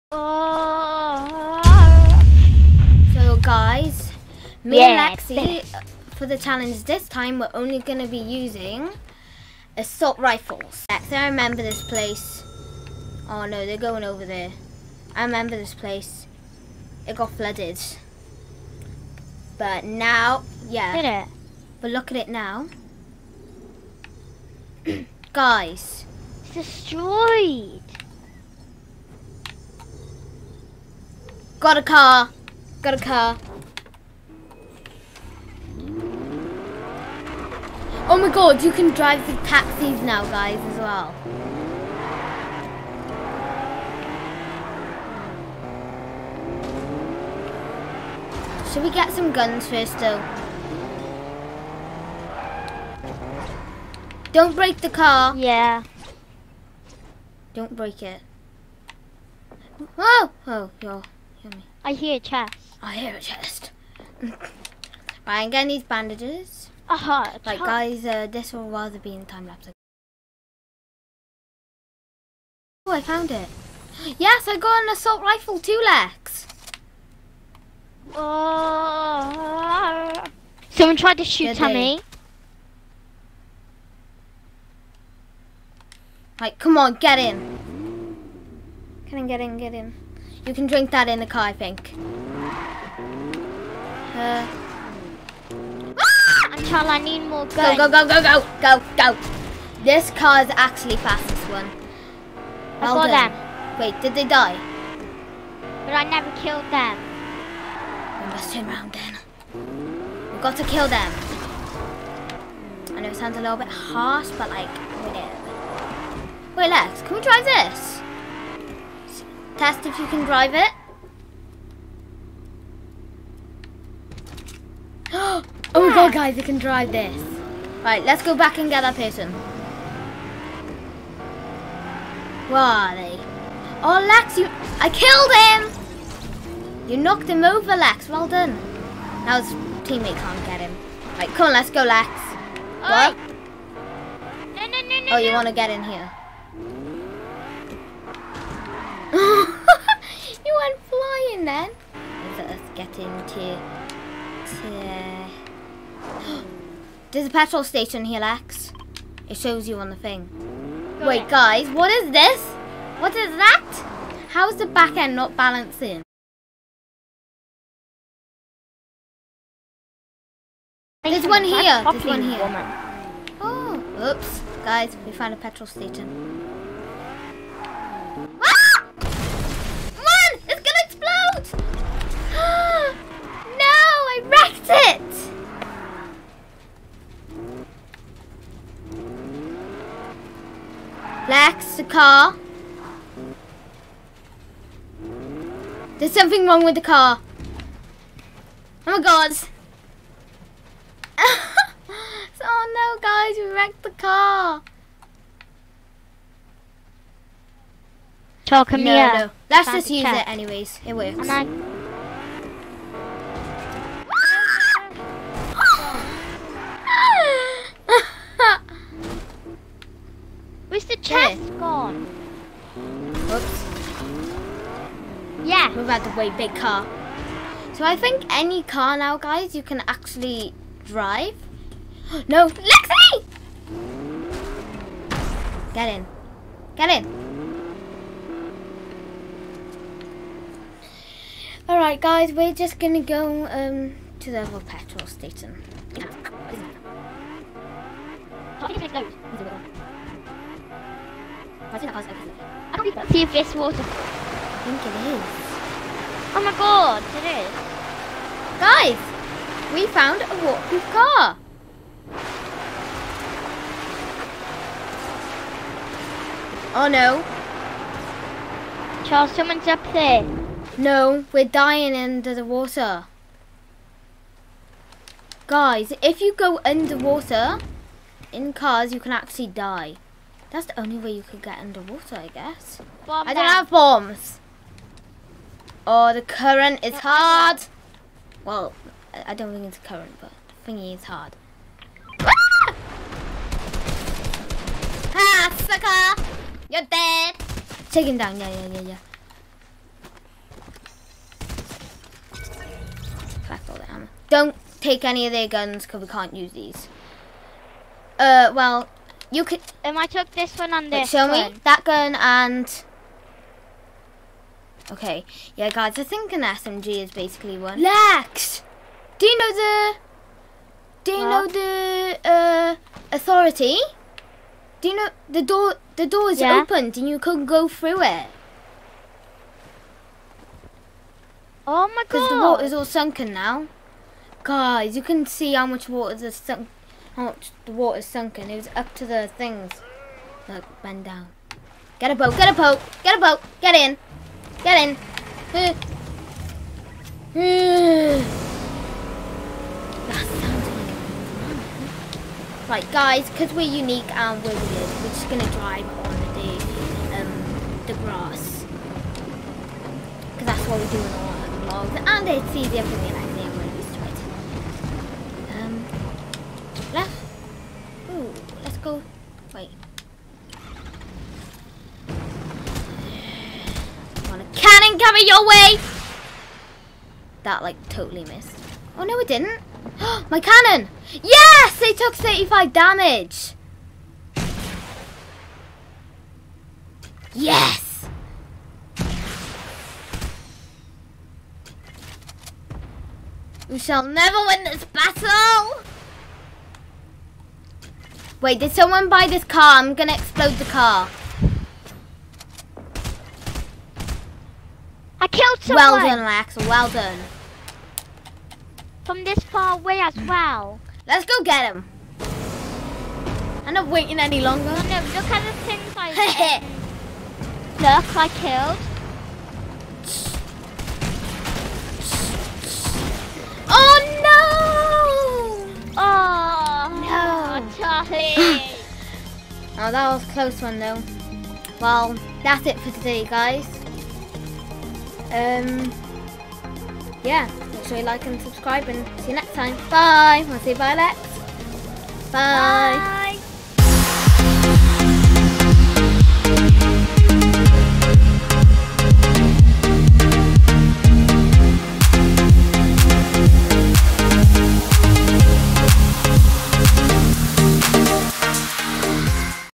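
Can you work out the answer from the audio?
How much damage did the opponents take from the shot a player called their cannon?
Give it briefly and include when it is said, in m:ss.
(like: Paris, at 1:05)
35, at 6:22.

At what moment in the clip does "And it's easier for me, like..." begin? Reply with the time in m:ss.
6:02.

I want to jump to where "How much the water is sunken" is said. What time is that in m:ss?
5:37.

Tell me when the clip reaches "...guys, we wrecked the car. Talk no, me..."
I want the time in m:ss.
3:23.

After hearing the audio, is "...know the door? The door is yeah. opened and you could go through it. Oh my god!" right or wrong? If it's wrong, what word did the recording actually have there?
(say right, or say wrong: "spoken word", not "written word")
right.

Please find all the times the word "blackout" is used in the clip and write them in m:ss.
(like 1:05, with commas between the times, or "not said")
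not said.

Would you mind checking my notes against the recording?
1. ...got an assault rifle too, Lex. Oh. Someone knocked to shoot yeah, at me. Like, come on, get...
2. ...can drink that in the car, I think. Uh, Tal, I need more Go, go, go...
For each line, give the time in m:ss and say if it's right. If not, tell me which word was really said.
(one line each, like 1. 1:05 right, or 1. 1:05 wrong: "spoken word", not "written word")
1. 1:14 wrong: "tried", not "knocked"
2. 1:30 right.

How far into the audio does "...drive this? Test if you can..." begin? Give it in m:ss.
1:57.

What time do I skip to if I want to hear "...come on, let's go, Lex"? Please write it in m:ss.
2:21.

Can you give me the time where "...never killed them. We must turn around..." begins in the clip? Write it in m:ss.
1:46.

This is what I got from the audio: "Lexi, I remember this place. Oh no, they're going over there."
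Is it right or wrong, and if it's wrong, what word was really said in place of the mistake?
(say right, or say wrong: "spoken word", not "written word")
right.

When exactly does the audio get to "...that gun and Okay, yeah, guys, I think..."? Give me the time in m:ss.
5:11.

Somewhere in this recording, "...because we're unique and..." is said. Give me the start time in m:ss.
5:53.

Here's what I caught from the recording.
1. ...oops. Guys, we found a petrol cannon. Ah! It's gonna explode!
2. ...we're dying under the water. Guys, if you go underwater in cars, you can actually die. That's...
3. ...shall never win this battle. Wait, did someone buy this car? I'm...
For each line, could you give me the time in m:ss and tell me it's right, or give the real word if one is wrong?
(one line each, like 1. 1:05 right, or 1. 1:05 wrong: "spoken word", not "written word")
1. 2:54 wrong: "station", not "cannon"
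2. 4:31 right
3. 6:33 right.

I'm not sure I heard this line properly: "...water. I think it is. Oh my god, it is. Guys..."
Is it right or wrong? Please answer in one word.
right.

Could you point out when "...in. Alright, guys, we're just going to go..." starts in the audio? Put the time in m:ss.
3:56.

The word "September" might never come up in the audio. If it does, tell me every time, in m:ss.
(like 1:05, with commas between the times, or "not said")
not said.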